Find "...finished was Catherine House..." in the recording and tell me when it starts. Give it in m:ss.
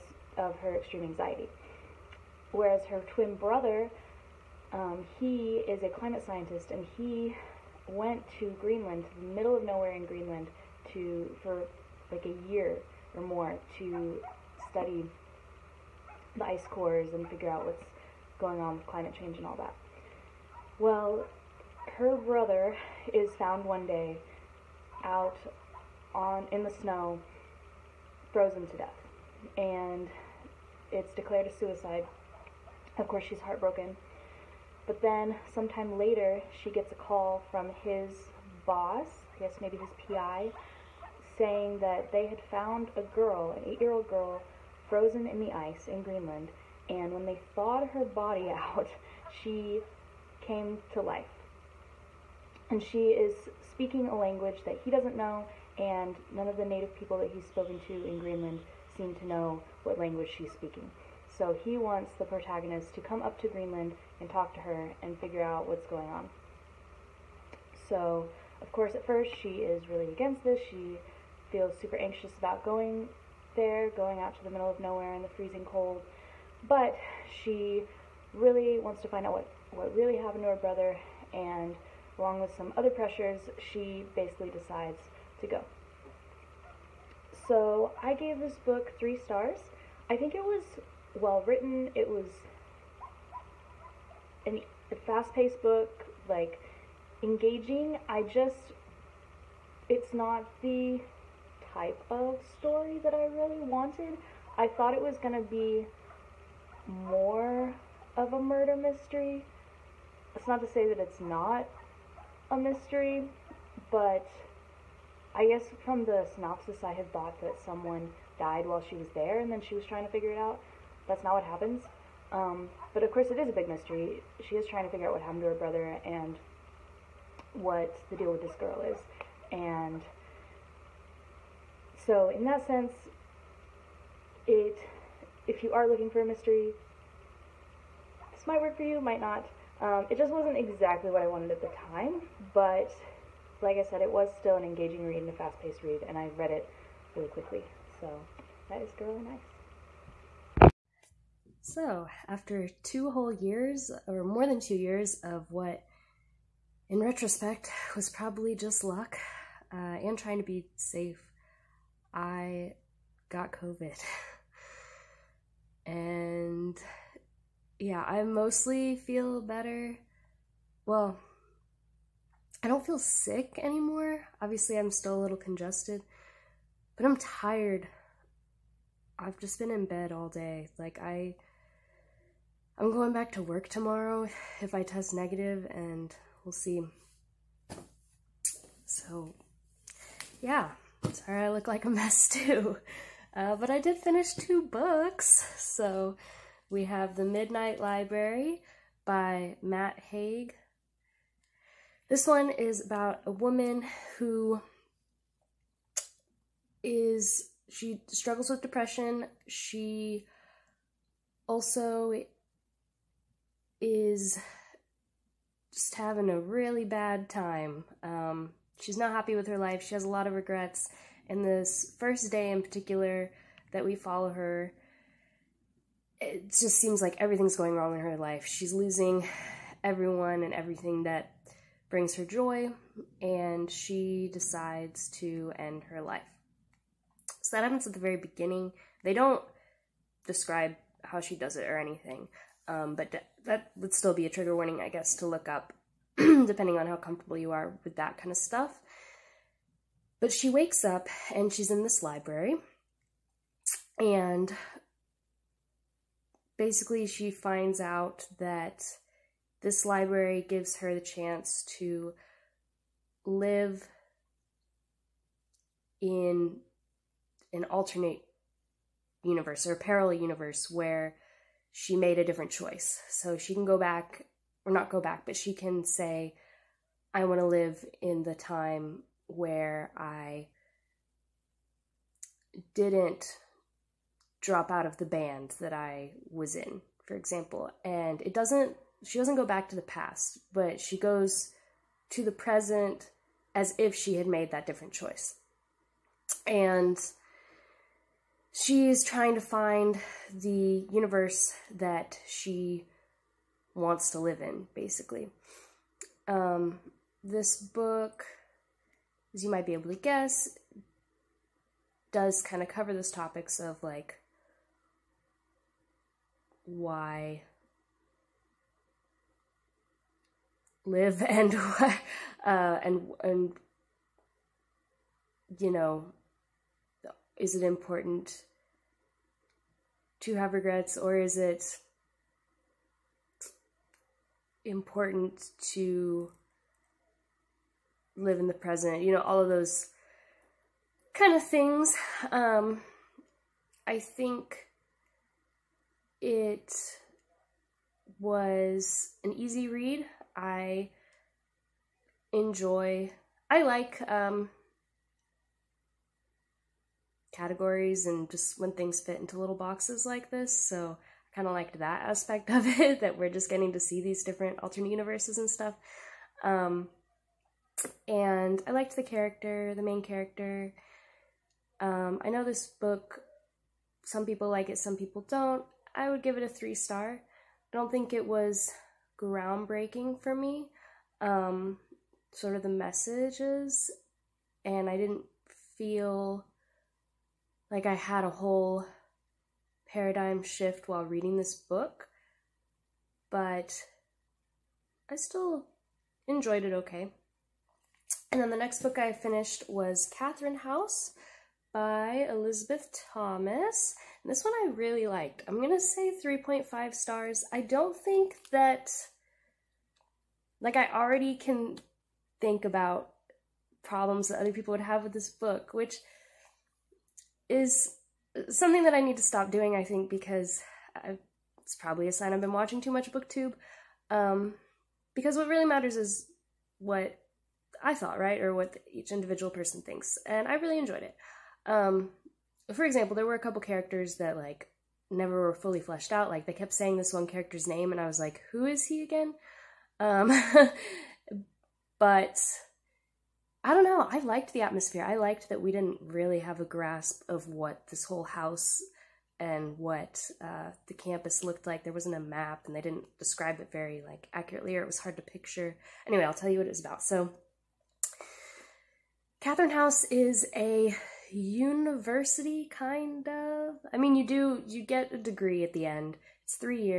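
6:39.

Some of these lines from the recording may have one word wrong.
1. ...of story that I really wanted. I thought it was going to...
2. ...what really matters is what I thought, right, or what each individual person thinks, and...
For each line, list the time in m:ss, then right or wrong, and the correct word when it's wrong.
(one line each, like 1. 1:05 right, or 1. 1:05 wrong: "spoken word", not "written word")
1. 1:42 right
2. 7:05 right.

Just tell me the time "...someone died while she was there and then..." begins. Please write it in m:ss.
1:57.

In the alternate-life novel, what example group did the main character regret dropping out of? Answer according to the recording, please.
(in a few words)
the band.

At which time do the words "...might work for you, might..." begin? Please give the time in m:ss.
2:18.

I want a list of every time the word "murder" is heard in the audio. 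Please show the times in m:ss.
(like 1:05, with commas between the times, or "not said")
1:48.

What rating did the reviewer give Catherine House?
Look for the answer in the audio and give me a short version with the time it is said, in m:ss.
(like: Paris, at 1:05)
3.5 stars, at 6:46.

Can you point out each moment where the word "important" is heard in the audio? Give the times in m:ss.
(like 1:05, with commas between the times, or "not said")
5:27, 5:34.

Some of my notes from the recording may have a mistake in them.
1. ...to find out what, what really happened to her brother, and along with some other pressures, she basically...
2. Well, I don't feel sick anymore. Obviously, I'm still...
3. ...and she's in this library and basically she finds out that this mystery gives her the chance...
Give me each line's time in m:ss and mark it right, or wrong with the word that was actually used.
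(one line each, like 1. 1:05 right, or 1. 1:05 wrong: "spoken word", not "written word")
1. 1:19 right
2. 2:50 right
3. 4:11 wrong: "library", not "mystery".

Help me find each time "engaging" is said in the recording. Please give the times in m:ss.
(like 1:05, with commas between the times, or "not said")
1:37, 2:24.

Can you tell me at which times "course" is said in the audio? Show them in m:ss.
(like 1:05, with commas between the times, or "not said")
0:33, 1:08, 2:03.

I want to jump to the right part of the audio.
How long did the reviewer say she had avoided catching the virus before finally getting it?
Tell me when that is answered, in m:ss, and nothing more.
2:34.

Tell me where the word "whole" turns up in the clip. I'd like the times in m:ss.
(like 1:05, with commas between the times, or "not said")
2:33, 6:28, 7:28.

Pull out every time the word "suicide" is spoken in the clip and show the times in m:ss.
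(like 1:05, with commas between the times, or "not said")
0:31.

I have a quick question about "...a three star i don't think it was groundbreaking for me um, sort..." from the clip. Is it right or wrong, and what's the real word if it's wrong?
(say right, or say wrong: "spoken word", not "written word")
right.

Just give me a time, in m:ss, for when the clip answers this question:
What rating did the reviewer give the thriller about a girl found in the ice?
1:28.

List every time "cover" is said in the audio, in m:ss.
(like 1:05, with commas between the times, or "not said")
5:12.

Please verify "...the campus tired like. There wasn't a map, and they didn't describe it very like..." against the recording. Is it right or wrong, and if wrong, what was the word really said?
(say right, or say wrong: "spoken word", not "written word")
wrong: "looked", not "tired".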